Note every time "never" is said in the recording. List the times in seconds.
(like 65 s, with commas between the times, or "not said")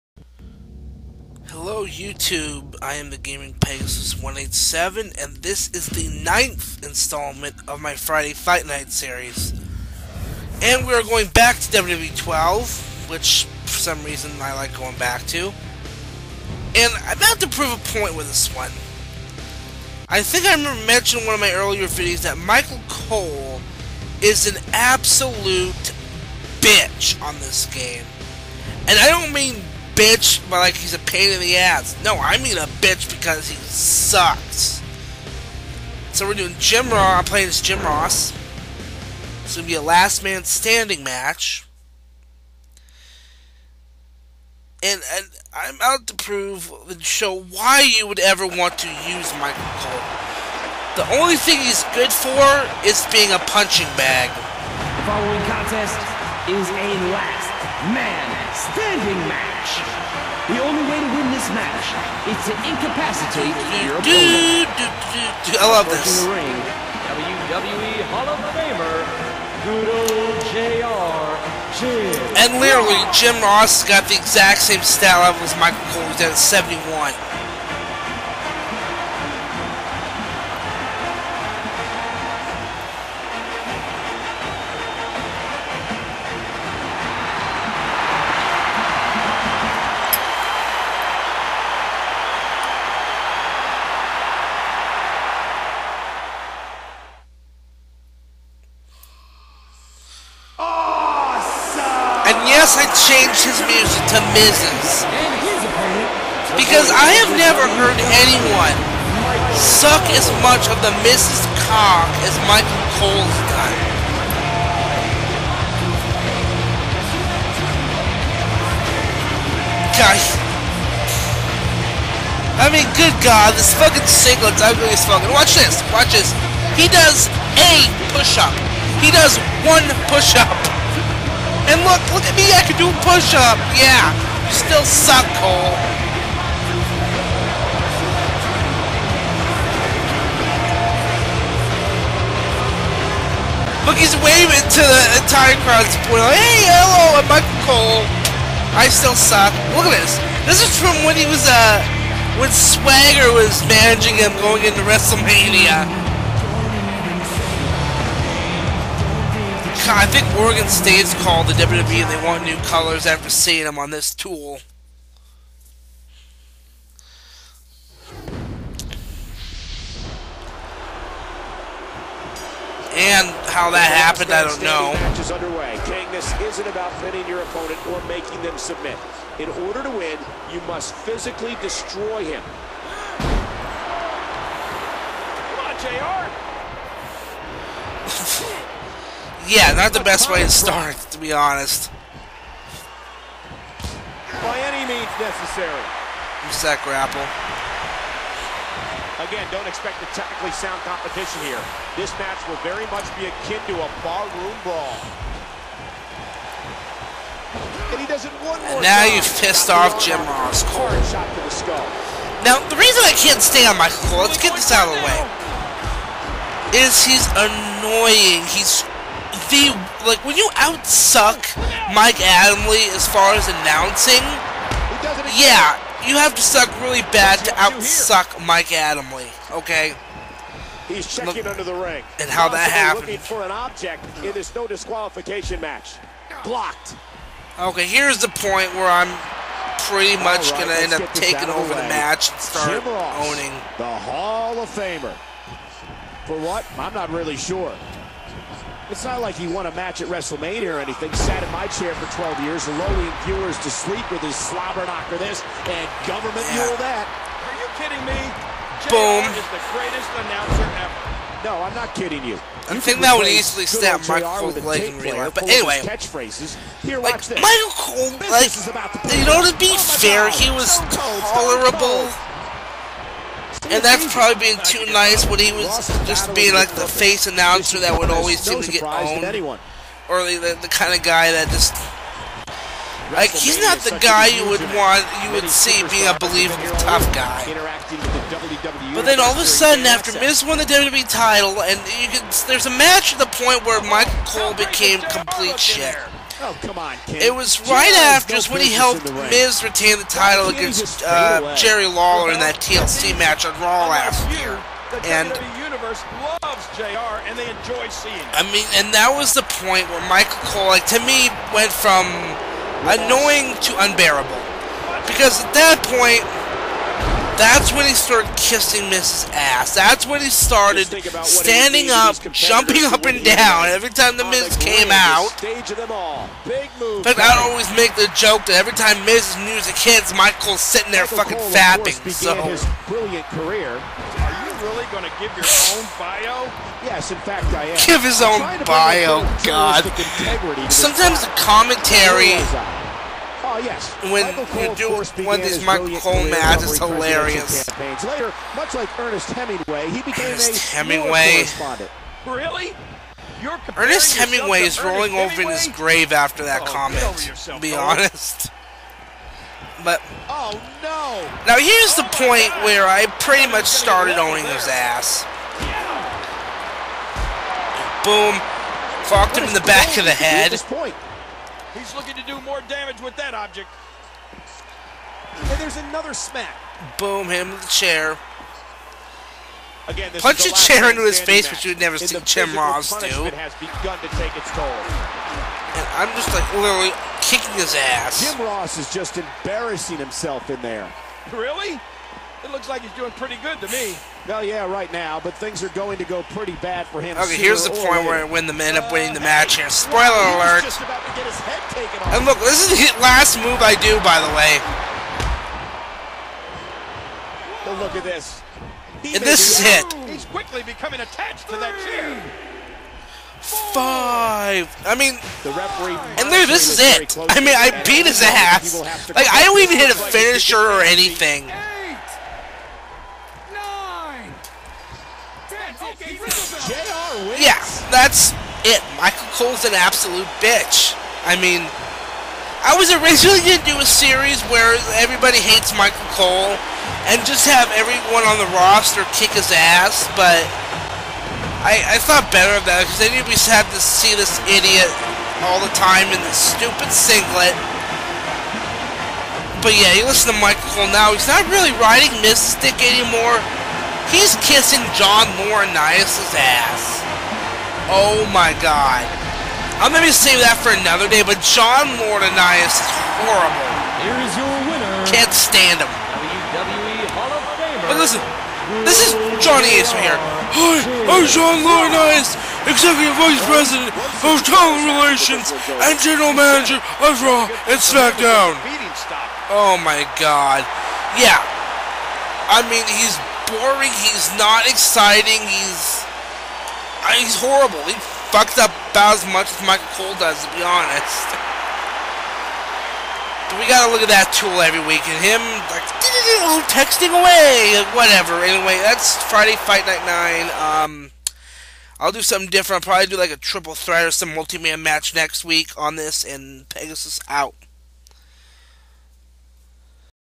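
107 s, 381 s.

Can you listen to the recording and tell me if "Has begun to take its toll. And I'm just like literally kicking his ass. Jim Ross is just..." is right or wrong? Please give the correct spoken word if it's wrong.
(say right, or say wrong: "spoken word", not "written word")
right.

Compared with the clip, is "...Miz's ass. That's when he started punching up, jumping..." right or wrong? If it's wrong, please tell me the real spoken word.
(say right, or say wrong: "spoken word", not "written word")
wrong: "standing", not "punching".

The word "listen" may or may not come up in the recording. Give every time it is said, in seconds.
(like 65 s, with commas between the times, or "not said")
450 s, 467 s.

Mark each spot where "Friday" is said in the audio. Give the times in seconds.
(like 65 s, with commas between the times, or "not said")
7 s, 499 s.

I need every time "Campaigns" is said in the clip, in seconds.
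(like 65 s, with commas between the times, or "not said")
347 s.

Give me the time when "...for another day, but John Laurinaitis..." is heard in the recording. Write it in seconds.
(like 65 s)
460 s.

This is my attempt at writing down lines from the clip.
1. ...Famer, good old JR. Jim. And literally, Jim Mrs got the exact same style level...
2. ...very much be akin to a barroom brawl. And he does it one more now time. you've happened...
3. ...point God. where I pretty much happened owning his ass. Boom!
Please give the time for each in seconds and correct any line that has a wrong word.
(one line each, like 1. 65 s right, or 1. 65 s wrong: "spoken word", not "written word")
1. 68 s wrong: "Ross", not "Mrs"
2. 202 s wrong: "pissed", not "happened"
3. 362 s wrong: "started", not "happened".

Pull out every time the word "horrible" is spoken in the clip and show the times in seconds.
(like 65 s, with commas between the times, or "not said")
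463 s, 487 s.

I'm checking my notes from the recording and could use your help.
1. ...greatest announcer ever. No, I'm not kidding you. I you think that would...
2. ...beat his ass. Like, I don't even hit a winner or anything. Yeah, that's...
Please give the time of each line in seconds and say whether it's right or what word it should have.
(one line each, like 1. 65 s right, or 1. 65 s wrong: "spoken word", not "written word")
1. 259 s right
2. 417 s wrong: "finisher", not "winner".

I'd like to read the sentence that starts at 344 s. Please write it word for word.
When you do when these Michael Cole is hilarious.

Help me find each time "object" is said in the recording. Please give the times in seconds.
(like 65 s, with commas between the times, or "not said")
233 s, 373 s.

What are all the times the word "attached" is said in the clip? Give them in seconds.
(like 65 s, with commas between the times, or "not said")
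411 s.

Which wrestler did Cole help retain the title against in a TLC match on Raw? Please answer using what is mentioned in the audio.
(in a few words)
Jerry Lawler.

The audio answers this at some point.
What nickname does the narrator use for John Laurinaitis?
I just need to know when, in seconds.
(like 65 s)
469 s.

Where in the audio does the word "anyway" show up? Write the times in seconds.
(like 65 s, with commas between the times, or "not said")
265 s, 498 s.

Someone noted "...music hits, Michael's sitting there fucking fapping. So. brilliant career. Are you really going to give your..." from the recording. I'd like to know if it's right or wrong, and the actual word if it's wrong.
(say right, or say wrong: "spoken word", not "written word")
right.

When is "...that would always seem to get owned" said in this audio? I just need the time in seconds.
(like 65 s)
277 s.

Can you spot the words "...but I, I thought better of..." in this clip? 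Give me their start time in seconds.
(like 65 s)
440 s.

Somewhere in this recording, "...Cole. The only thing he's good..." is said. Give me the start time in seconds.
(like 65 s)
49 s.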